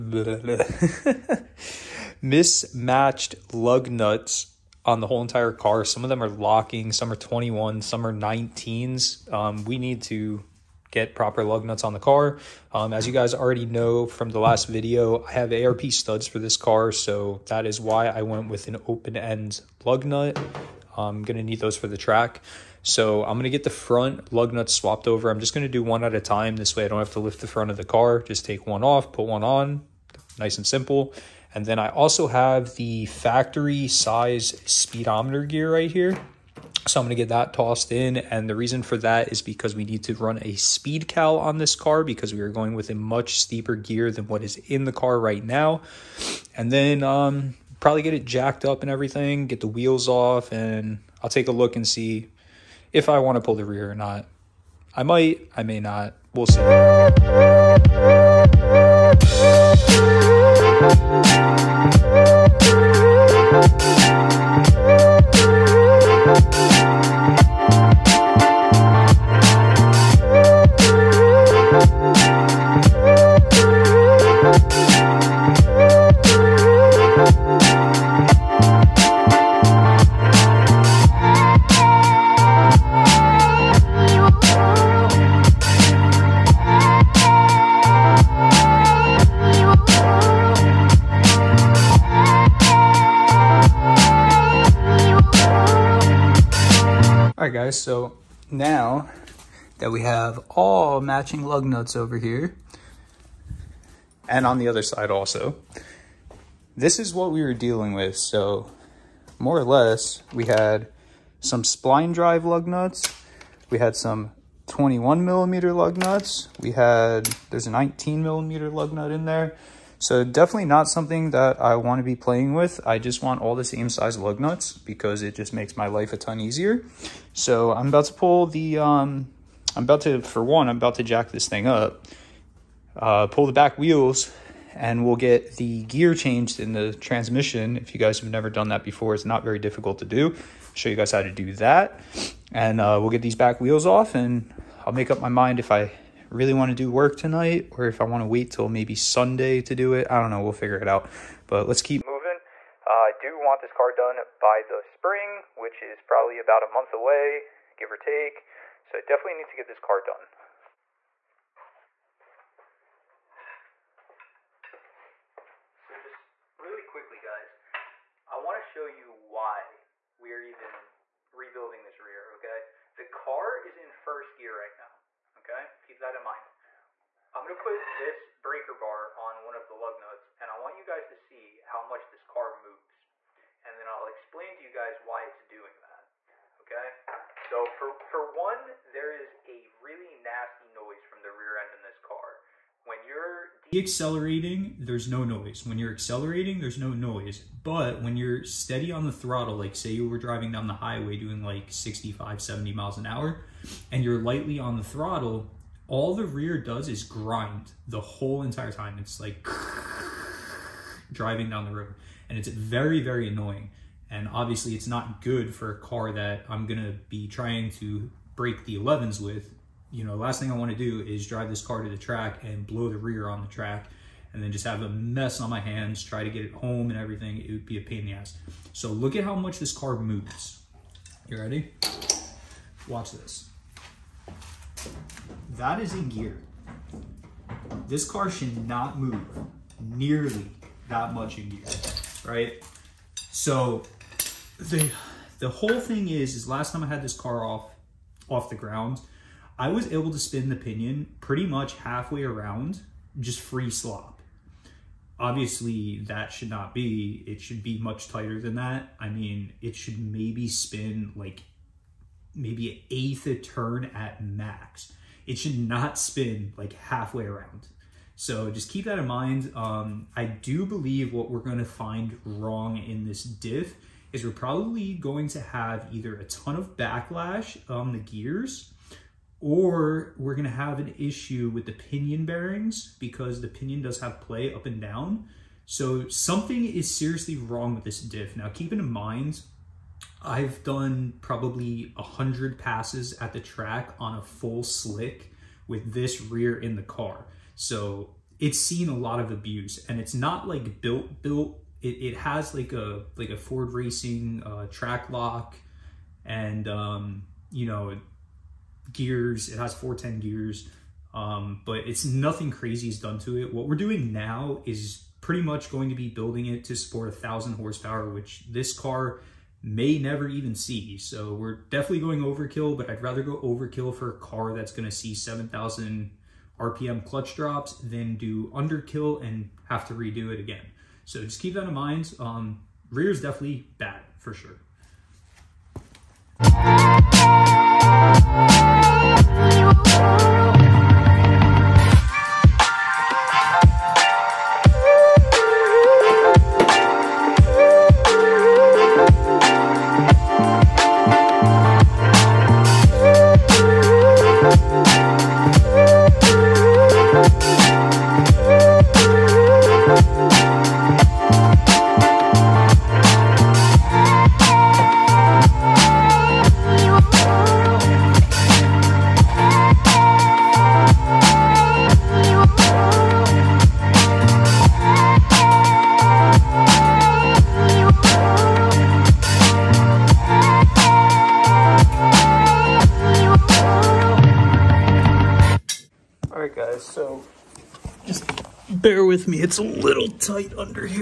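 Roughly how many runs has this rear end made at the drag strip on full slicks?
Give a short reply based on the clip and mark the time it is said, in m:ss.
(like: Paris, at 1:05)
100, at 4:51.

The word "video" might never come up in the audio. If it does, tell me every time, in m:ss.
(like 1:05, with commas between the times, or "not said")
0:14.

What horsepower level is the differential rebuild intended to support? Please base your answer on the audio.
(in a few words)
1,000 horsepower.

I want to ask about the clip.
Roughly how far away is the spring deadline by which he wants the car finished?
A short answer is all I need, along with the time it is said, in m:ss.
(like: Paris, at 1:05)
about a month, at 2:36.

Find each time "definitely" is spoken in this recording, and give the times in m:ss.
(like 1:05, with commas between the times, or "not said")
2:00, 2:39, 5:21, 5:33.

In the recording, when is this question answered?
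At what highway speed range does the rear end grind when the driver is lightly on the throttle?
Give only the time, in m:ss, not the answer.
3:21.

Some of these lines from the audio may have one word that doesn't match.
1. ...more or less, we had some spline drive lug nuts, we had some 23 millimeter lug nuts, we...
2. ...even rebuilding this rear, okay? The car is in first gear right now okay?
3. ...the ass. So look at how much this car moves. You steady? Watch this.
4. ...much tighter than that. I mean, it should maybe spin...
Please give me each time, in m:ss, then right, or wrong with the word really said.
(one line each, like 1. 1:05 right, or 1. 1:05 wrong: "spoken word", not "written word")
1. 1:49 wrong: "21", not "23"
2. 2:50 right
3. 3:48 wrong: "ready", not "steady"
4. 4:17 right.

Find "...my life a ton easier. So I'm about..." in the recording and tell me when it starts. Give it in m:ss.
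2:05.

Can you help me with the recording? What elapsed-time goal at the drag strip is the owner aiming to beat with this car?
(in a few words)
the 11s.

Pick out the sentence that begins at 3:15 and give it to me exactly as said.
When you're accelerating, there's no noise.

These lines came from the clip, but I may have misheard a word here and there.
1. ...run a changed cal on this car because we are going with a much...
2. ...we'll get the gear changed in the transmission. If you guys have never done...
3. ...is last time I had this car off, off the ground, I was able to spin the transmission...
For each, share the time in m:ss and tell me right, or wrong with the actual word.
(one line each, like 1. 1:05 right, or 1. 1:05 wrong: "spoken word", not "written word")
1. 0:40 wrong: "speed", not "changed"
2. 2:15 right
3. 4:06 wrong: "pinion", not "transmission".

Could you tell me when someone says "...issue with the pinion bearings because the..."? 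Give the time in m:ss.
4:40.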